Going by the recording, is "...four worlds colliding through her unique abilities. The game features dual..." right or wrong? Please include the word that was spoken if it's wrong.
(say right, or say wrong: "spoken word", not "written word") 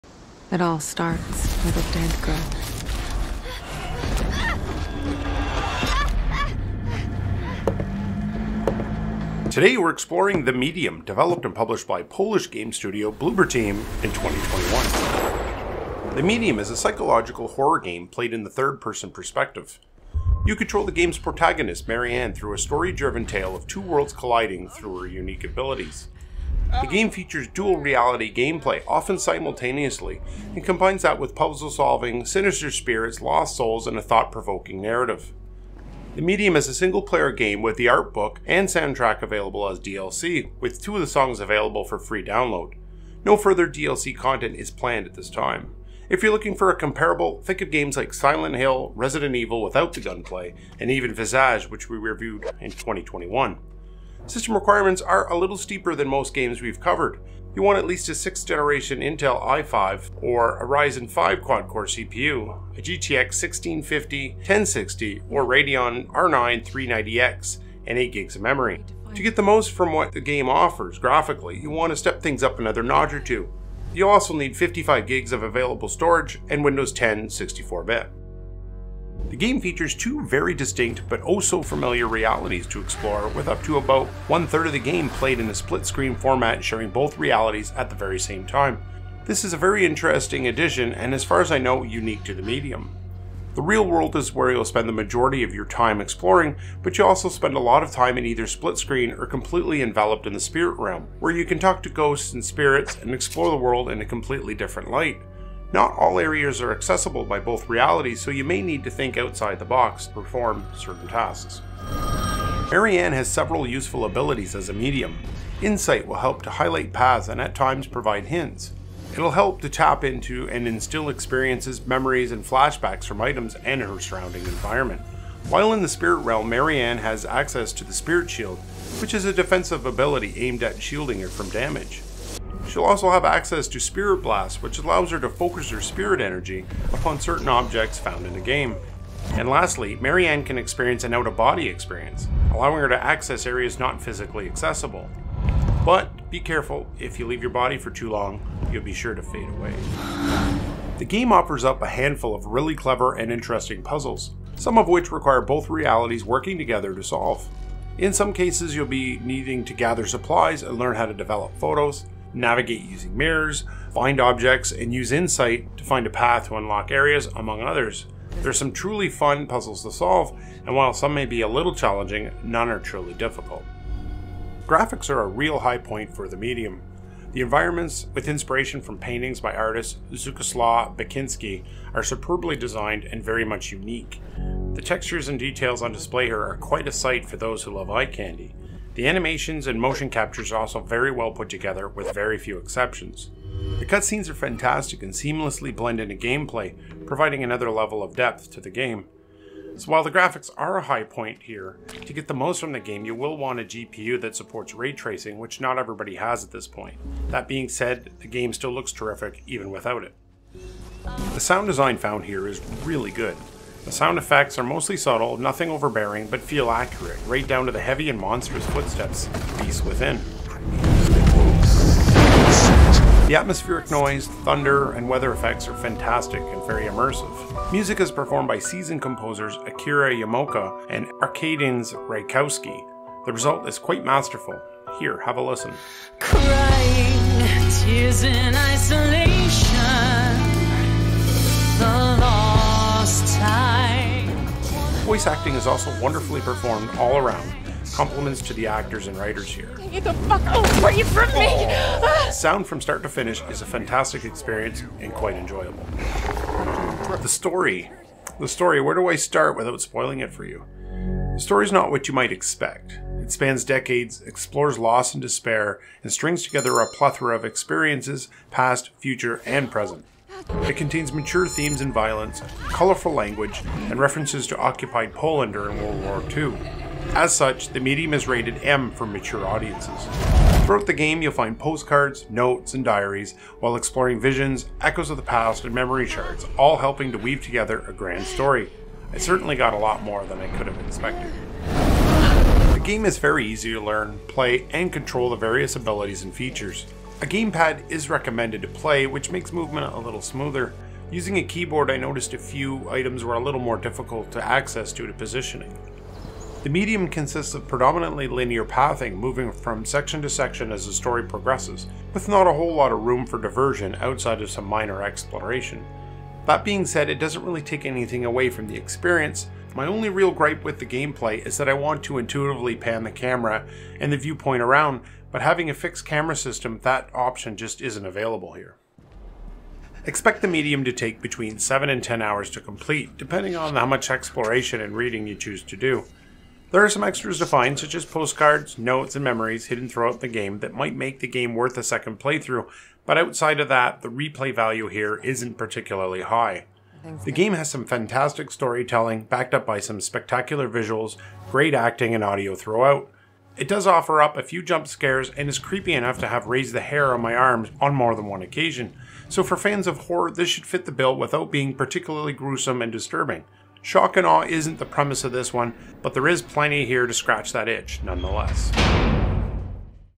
wrong: "two", not "four".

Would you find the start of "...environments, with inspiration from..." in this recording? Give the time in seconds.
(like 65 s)
177 s.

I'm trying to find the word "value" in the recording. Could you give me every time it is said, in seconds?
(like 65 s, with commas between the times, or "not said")
344 s.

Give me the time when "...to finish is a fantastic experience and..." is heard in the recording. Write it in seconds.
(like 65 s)
253 s.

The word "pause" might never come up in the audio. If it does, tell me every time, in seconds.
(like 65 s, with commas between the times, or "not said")
not said.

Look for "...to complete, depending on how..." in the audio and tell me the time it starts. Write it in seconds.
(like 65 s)
332 s.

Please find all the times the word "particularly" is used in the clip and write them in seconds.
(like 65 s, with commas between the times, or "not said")
345 s, 361 s.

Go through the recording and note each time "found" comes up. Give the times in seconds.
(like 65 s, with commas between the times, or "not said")
137 s, 211 s.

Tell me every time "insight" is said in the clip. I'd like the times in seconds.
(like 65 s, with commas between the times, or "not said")
115 s, 165 s.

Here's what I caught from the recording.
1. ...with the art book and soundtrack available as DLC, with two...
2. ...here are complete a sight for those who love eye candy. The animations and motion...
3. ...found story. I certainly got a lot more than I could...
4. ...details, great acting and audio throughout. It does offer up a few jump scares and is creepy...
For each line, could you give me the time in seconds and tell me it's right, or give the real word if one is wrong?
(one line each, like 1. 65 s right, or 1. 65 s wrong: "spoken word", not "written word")
1. 37 s right
2. 186 s wrong: "quite", not "complete"
3. 287 s wrong: "grand", not "found"
4. 350 s wrong: "visuals", not "details".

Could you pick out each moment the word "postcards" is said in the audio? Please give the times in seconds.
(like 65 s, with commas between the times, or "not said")
281 s, 338 s.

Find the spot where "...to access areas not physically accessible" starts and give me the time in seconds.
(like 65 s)
142 s.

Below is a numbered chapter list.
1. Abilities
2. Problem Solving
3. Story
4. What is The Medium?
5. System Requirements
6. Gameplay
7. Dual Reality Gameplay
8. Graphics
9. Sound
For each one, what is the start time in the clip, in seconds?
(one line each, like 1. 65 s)
1. 112 s
2. 150 s
3. 257 s
4. 16 s
5. 54 s
6. 292 s
7. 79 s
8. 174 s
9. 211 s.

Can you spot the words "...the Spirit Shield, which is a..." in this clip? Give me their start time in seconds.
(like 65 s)
127 s.